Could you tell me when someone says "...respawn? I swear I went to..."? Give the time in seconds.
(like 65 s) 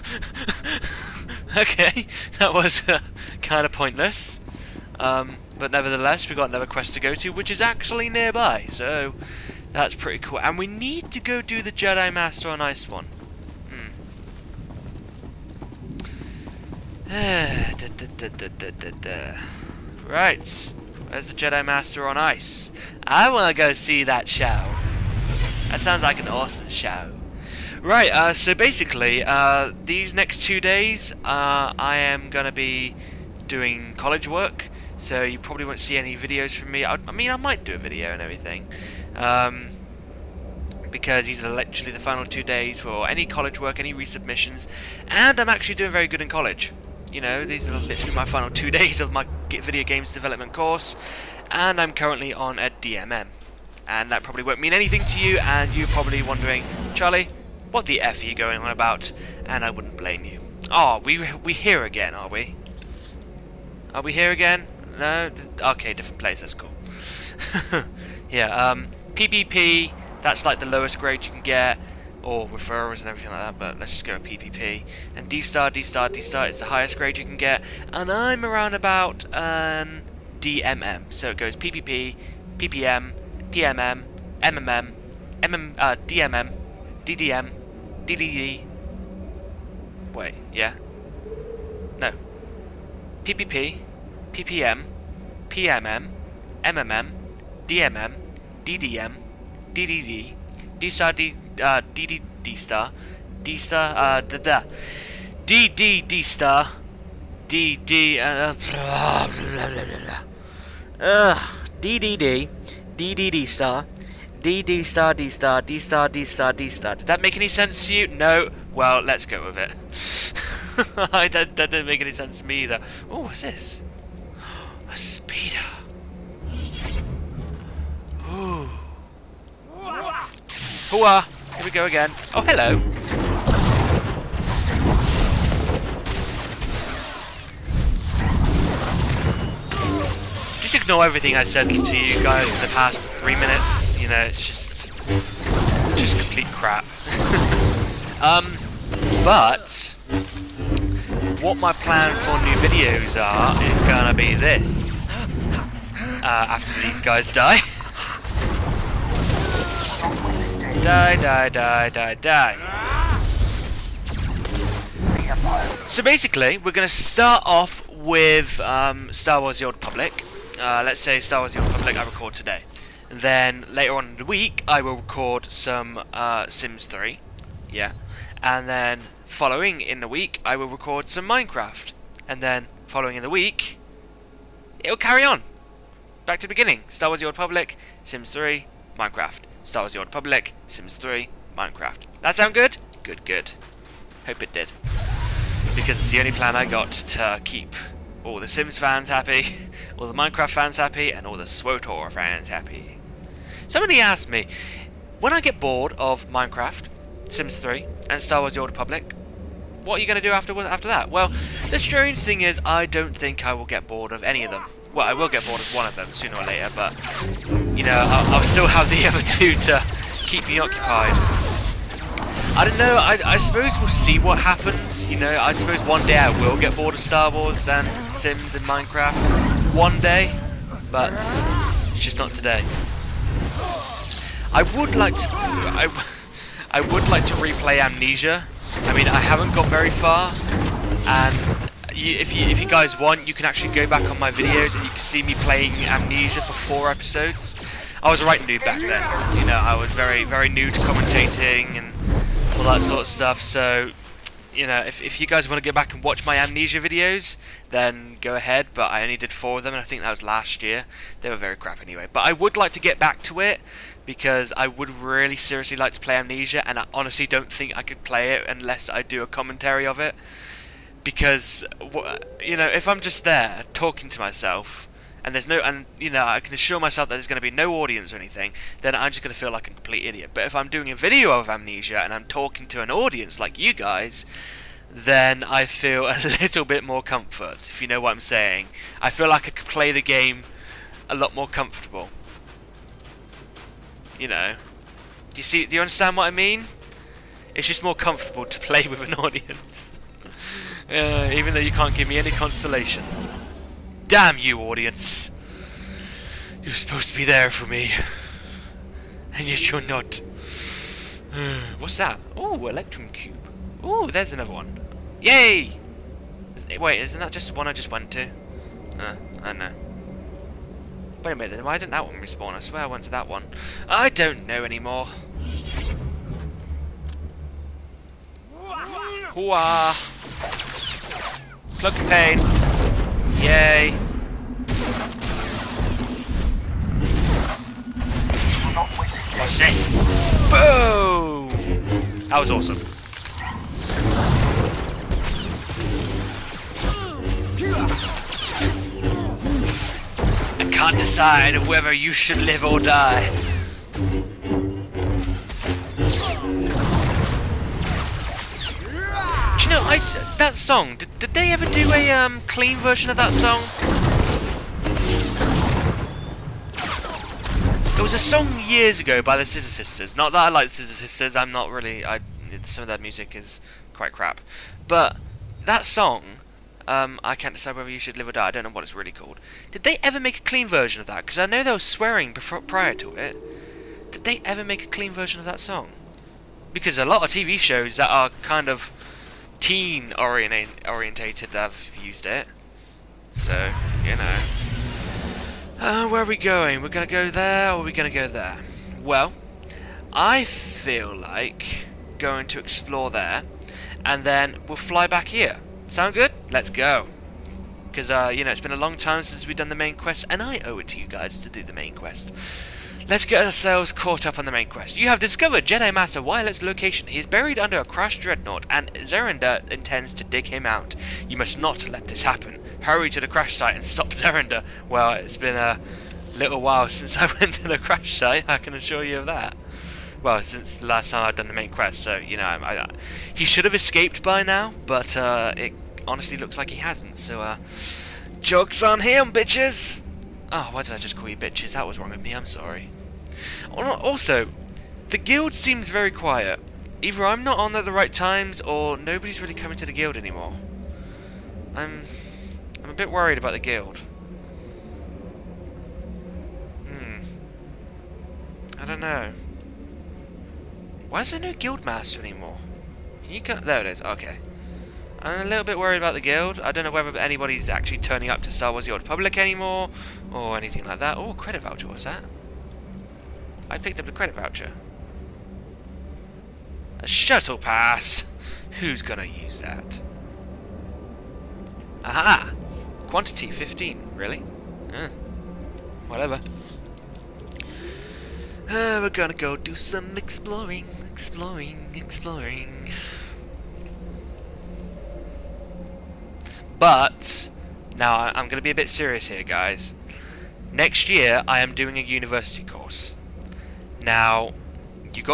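322 s.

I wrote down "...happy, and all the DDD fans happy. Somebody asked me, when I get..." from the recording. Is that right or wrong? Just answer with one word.
wrong.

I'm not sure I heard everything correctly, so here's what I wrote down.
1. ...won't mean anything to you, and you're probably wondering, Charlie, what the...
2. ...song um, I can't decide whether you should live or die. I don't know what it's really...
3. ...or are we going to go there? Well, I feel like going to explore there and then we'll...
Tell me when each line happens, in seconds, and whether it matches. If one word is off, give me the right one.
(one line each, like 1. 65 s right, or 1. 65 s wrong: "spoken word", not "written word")
1. 54 s right
2. 375 s right
3. 397 s right.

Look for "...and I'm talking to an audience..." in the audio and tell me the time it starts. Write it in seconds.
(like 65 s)
282 s.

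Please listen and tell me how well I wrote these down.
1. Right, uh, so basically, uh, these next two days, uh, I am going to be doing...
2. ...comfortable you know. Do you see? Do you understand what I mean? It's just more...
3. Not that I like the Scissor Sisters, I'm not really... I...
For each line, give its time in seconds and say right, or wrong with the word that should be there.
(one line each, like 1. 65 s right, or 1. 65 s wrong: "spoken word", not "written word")
1. 27 s right
2. 291 s right
3. 370 s right.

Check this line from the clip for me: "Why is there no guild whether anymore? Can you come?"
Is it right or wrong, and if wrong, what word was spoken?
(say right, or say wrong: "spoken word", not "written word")
wrong: "master", not "whether".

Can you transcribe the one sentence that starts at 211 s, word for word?
Well, the strange thing is I don't think I will get bored of any of them.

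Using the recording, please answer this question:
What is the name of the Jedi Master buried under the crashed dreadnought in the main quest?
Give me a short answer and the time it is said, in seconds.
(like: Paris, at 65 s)
Wylet, at 416 s.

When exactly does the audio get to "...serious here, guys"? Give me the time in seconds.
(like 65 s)
498 s.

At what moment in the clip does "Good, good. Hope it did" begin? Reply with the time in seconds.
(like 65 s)
193 s.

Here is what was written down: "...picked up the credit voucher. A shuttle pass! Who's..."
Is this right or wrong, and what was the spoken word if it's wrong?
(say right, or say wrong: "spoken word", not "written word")
right.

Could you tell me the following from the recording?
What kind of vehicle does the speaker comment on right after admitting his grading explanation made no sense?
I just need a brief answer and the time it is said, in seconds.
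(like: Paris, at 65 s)
speeder, at 124 s.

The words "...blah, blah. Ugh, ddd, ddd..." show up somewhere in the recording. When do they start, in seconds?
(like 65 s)
109 s.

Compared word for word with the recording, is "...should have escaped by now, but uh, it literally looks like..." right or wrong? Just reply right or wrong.
wrong.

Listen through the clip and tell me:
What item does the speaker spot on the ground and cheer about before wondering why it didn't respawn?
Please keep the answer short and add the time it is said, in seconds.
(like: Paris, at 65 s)
Electrum Cube, at 312 s.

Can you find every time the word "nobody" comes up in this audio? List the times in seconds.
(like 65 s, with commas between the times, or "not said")
448 s.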